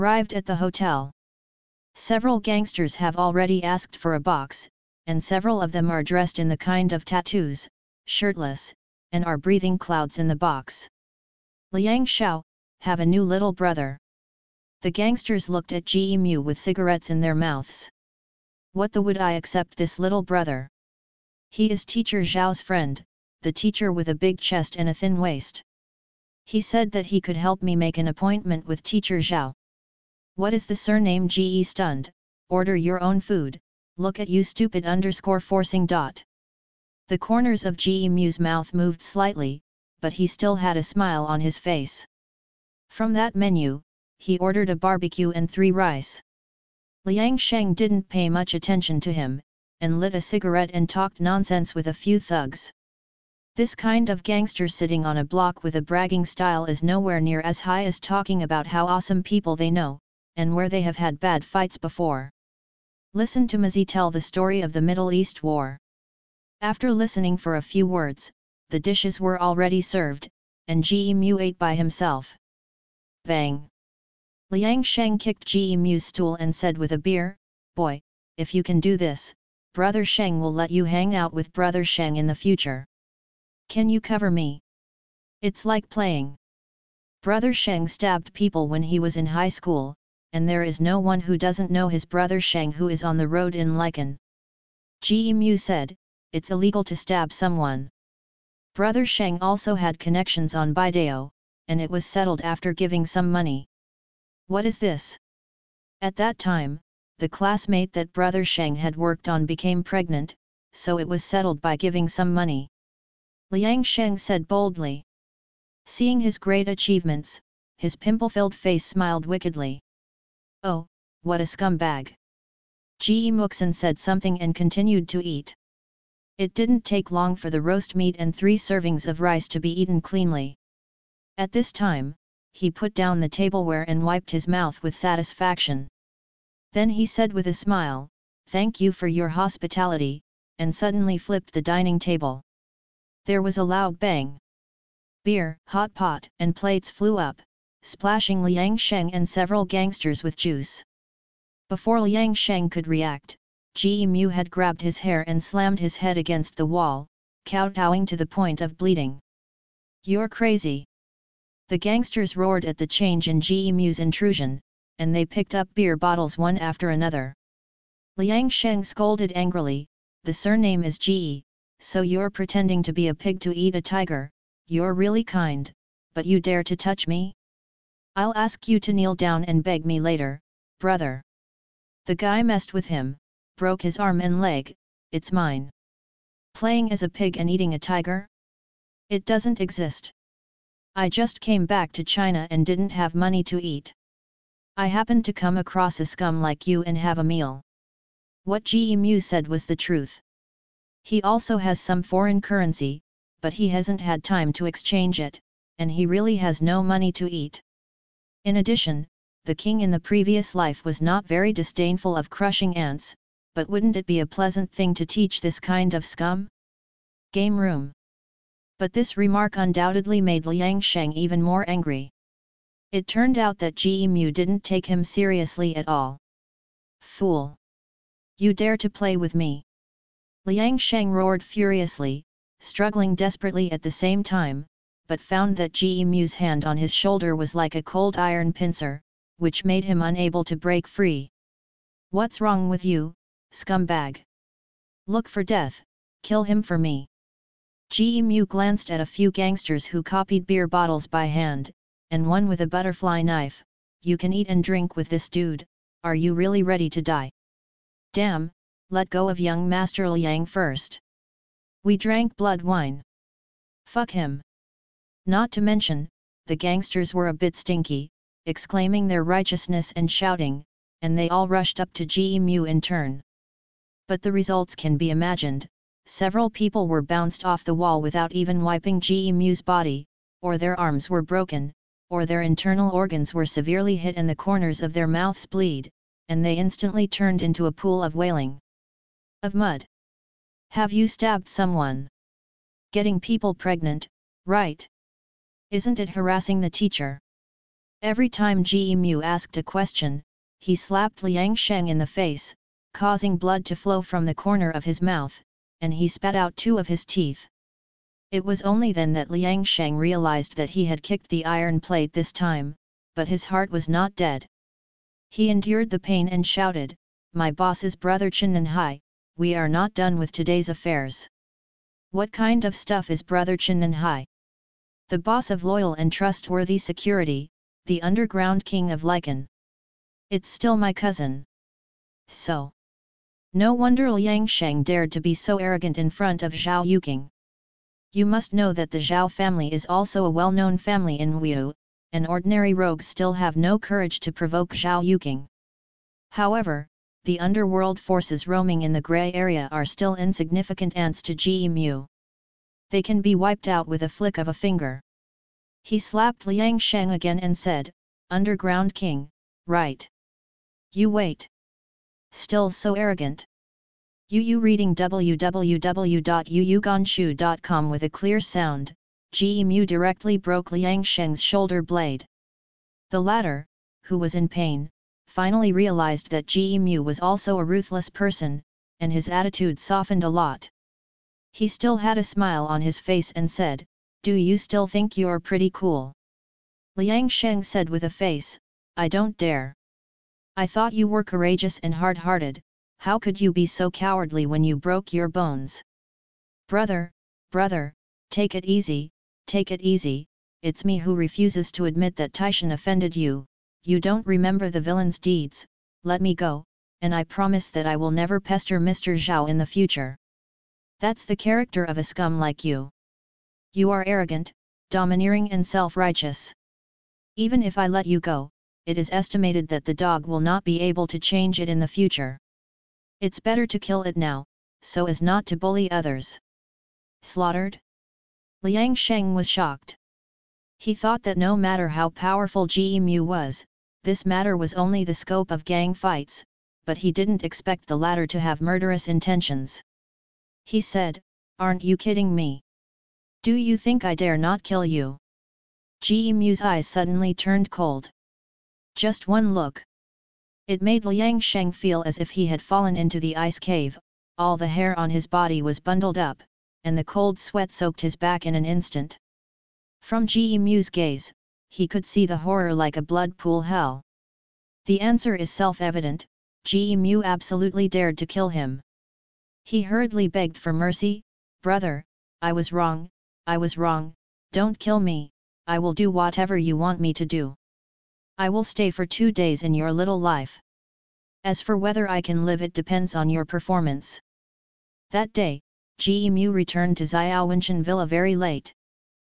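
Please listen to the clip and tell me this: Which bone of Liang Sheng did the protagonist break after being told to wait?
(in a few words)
Shoulder blade.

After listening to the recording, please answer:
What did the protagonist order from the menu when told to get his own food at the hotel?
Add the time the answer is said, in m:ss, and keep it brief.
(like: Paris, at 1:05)
A barbecue and three rice, at 0:44.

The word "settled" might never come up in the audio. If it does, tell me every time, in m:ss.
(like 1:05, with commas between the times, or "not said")
1:42, 1:51.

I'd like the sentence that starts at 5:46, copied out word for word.
However, the underworld forces roaming in the grey area are still insignificant ants to Ge Mu.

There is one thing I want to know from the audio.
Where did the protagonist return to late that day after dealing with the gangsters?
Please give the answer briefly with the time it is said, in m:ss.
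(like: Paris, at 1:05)
Xiaowenchen Villa, at 8:07.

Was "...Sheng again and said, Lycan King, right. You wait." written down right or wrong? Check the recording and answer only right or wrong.
wrong.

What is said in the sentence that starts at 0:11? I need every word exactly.
Liang Shao, have a new little brother.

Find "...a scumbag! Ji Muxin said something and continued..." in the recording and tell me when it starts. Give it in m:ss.
2:01.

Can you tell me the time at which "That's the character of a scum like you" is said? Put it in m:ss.
6:50.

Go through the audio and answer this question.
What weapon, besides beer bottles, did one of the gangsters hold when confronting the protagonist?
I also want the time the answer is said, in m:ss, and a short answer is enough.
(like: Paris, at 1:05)
Butterfly knife, at 4:12.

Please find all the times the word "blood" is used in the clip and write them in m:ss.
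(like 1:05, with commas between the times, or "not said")
4:22, 5:03, 7:43.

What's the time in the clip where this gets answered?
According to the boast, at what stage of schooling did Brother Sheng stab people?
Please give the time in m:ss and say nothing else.
1:29.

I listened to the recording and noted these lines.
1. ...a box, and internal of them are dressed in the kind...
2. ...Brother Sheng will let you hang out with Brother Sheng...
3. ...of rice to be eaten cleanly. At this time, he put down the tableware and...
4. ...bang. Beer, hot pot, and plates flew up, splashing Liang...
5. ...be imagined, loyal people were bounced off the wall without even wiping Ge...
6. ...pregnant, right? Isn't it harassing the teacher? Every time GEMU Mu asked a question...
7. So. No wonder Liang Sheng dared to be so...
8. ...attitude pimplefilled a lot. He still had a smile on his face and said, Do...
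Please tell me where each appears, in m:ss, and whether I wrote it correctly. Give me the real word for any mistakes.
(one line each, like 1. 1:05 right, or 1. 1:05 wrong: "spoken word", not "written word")
1. 0:04 wrong: "several", not "internal"
2. 1:19 right
3. 2:09 right
4. 2:23 right
5. 4:34 wrong: "several", not "loyal"
6. 4:53 right
7. 5:32 right
8. 6:19 wrong: "softened", not "pimplefilled".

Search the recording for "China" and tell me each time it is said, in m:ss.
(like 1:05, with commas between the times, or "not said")
3:12.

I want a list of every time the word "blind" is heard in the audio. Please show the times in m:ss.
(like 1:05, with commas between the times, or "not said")
not said.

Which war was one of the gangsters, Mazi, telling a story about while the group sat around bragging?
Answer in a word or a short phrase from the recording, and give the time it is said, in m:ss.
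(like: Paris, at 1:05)
Middle East War, at 1:04.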